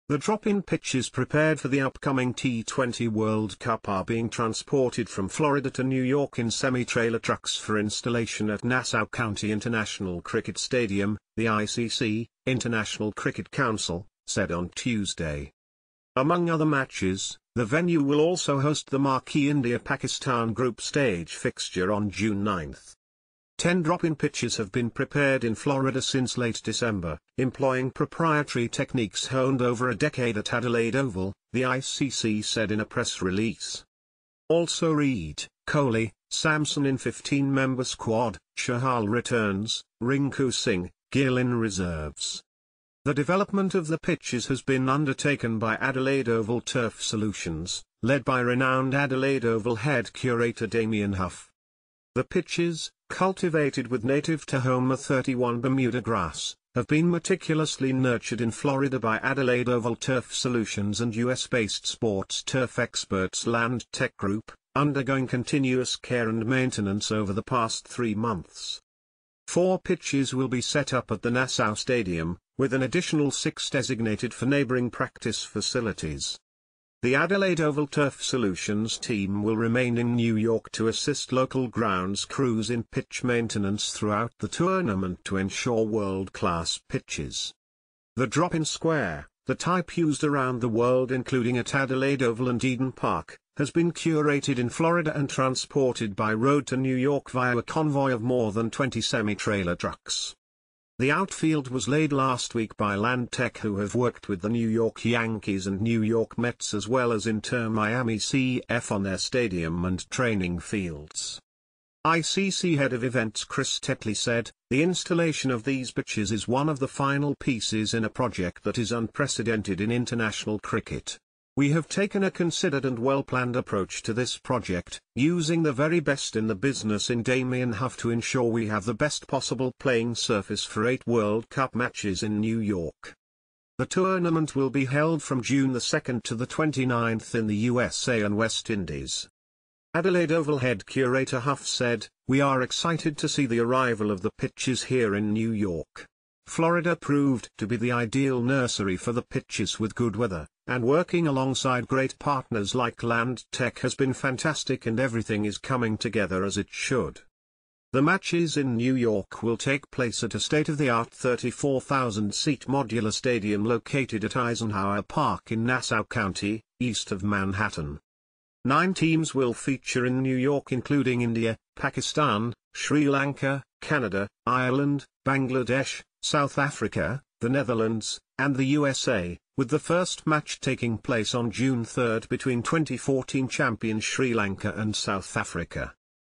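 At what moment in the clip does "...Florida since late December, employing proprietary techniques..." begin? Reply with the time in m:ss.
0:25.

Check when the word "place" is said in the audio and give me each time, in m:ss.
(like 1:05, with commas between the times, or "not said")
2:39, 3:00.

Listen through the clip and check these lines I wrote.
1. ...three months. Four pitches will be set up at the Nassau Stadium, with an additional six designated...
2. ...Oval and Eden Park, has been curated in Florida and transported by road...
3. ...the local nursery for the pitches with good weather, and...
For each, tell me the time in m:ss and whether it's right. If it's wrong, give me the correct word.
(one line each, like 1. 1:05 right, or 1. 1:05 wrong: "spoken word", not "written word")
1. 1:07 right
2. 1:32 right
3. 2:27 wrong: "ideal", not "local".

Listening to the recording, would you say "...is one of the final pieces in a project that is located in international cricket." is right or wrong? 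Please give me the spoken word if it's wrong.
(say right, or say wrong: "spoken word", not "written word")
wrong: "unprecedented", not "located".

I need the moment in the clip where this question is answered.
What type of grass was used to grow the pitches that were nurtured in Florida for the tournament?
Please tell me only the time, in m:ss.
0:54.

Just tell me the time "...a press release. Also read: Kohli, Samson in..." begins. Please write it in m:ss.
0:32.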